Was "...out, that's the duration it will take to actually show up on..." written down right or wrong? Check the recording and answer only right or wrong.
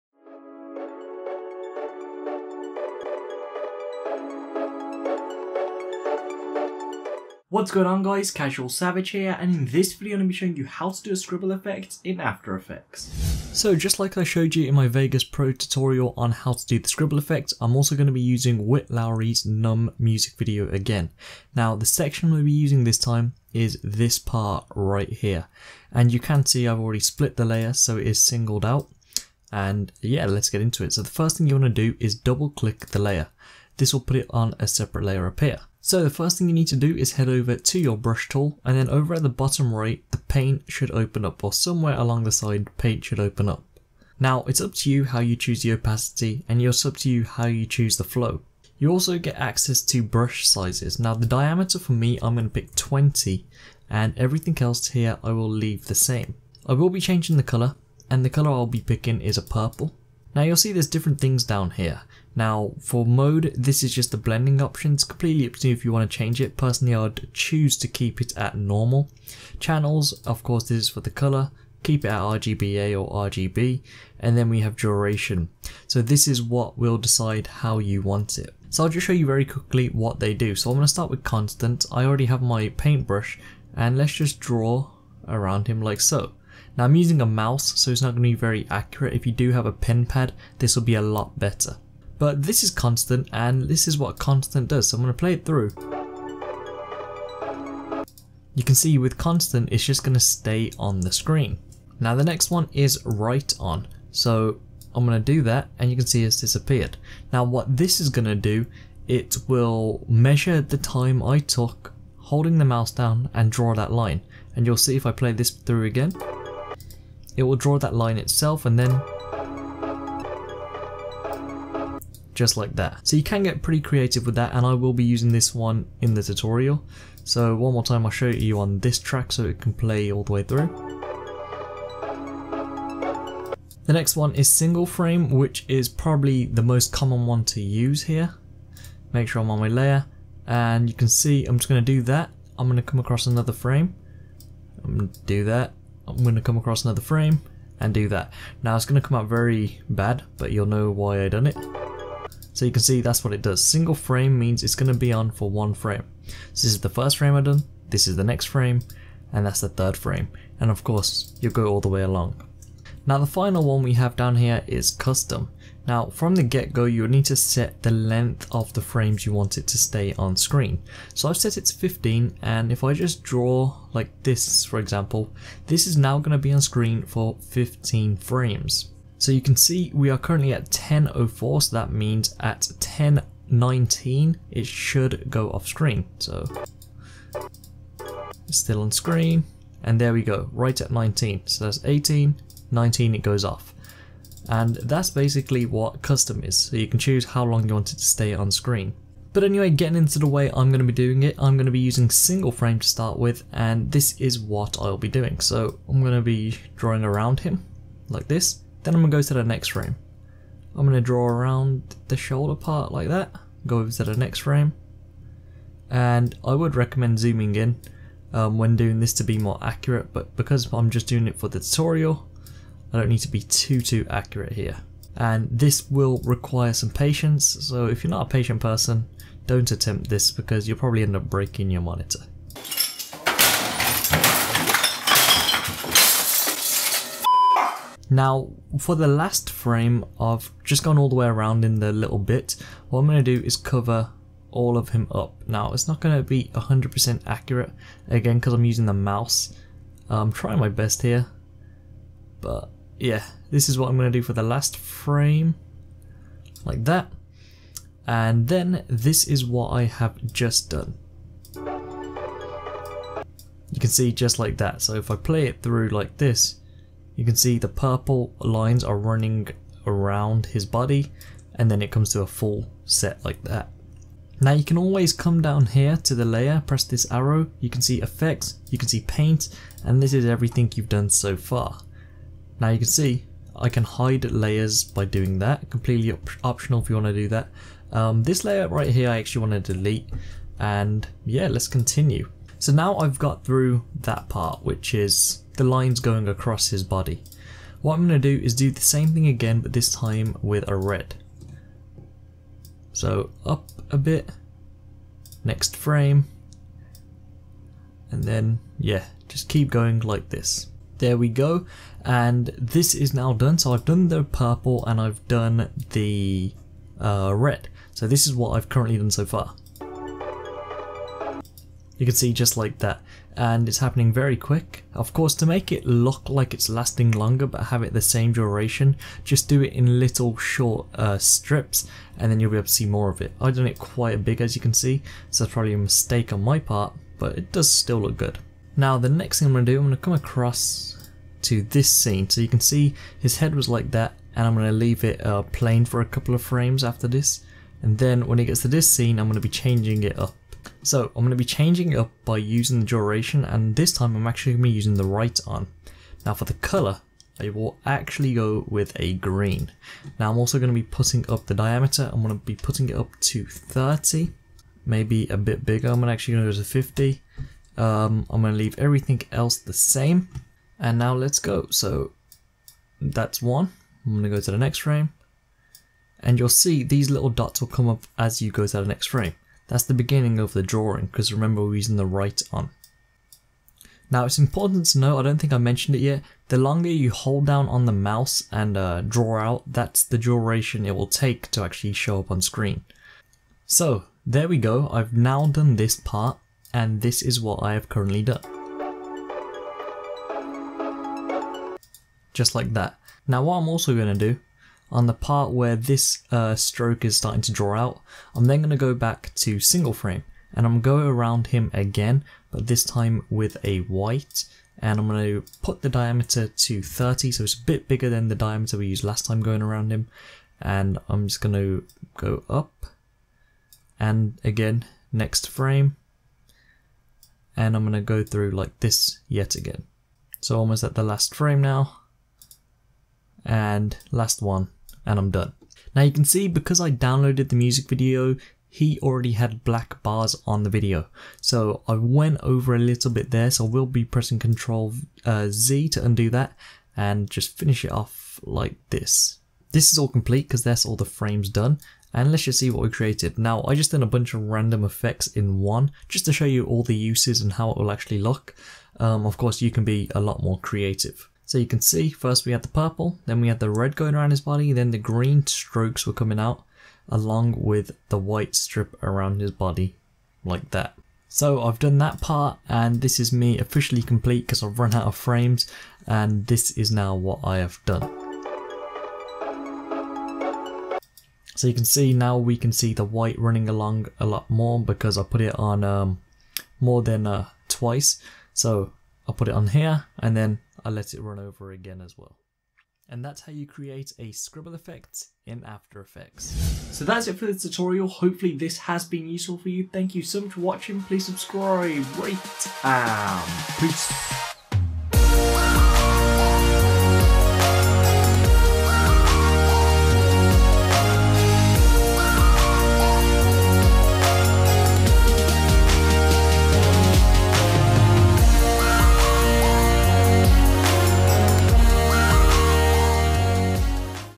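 right.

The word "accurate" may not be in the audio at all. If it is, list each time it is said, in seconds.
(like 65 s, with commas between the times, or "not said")
88 s, 219 s, 224 s, 247 s.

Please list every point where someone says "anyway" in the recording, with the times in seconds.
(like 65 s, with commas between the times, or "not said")
199 s.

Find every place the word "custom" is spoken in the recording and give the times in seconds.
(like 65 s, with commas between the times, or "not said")
164 s, 196 s.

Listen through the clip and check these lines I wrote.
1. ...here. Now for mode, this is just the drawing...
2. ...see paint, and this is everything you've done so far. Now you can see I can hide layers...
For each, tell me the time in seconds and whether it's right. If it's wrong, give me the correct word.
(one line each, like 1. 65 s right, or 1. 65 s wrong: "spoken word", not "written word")
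1. 61 s wrong: "blending", not "drawing"
2. 278 s right.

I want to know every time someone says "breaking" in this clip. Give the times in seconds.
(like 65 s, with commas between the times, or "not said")
231 s.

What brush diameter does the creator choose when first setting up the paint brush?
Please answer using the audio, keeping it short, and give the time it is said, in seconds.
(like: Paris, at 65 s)
20, at 52 s.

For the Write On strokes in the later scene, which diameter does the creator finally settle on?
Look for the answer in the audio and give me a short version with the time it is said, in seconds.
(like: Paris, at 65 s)
50, at 366 s.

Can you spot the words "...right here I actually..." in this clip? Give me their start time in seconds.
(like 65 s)
288 s.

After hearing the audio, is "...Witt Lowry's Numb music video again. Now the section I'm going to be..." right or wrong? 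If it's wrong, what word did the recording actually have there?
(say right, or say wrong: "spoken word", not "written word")
right.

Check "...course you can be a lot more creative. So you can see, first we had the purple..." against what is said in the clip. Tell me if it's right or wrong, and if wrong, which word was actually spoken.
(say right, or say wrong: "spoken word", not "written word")
right.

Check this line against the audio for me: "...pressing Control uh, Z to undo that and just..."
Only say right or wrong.
right.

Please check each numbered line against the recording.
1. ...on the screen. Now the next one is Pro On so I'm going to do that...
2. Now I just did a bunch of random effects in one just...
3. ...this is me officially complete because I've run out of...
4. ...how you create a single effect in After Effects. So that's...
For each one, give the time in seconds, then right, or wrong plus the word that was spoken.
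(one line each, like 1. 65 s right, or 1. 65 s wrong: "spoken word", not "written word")
1. 100 s wrong: "Write", not "Pro"
2. 453 s right
3. 473 s right
4. 493 s wrong: "scribble", not "single".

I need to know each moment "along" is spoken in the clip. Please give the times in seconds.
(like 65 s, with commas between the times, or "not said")
41 s, 162 s, 467 s, 483 s.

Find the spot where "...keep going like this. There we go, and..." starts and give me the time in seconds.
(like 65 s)
309 s.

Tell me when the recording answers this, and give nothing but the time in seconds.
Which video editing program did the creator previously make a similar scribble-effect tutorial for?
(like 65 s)
14 s.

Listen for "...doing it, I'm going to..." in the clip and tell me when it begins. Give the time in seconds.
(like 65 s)
200 s.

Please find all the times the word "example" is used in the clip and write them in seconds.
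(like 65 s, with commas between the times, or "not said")
174 s.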